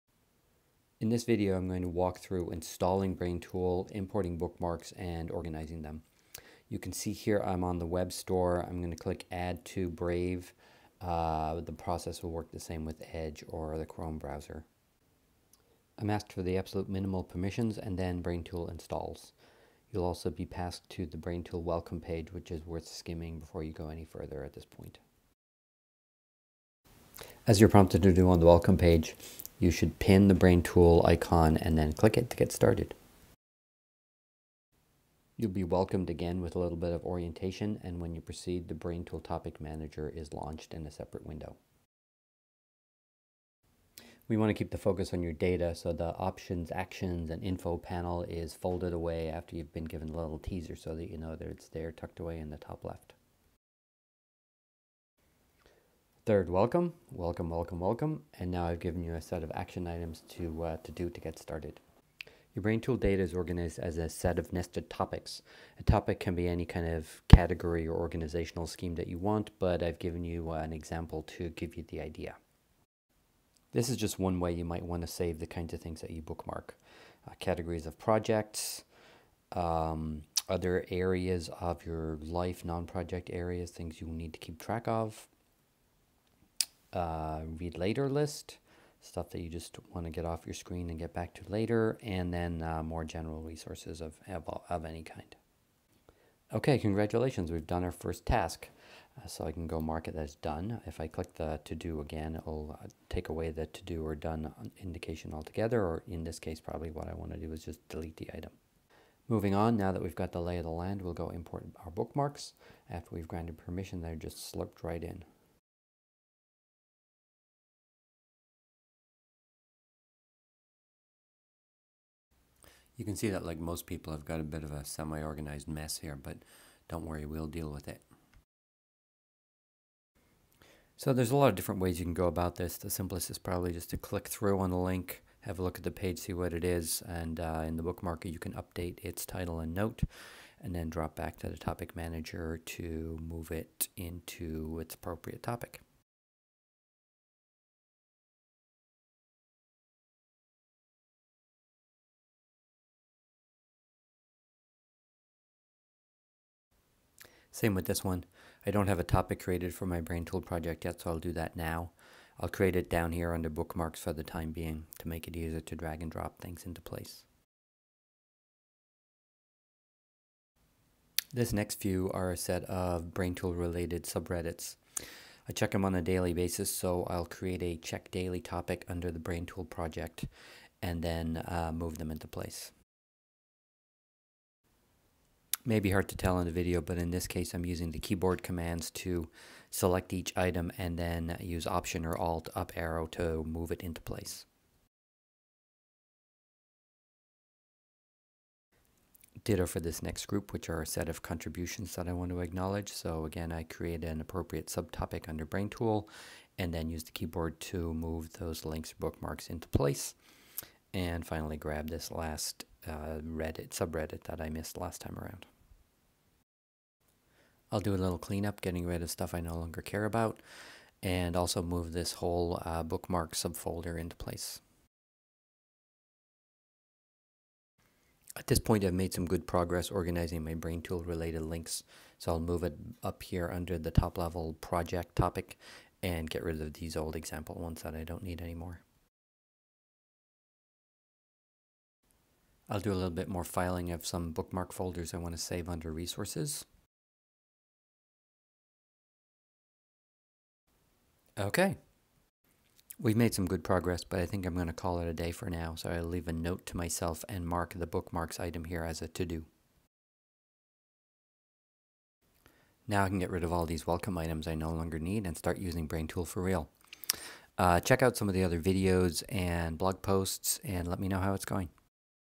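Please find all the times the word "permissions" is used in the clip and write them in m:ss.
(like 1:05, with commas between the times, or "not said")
0:17, 1:53.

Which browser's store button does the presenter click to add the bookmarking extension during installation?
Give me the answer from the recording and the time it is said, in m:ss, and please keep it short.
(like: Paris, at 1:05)
Brave, at 0:09.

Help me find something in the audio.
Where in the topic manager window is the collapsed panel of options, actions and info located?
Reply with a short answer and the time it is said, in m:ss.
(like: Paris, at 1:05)
top left, at 0:52.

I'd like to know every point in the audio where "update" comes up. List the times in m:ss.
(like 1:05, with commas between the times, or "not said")
2:18.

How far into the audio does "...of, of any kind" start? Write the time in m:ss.
1:34.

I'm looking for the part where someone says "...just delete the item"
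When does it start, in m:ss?
1:47.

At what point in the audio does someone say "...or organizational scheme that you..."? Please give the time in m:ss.
1:07.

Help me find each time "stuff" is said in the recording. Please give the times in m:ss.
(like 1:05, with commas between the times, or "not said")
1:29, 3:39.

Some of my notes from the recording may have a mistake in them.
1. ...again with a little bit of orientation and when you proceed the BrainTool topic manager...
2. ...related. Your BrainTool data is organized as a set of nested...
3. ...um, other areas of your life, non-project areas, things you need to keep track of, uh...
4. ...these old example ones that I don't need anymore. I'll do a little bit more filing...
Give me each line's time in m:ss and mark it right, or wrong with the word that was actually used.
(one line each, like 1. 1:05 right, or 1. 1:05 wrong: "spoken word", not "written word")
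1. 0:36 right
2. 1:01 wrong: "started", not "related"
3. 1:19 right
4. 3:56 right.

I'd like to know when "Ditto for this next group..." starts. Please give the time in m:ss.
3:19.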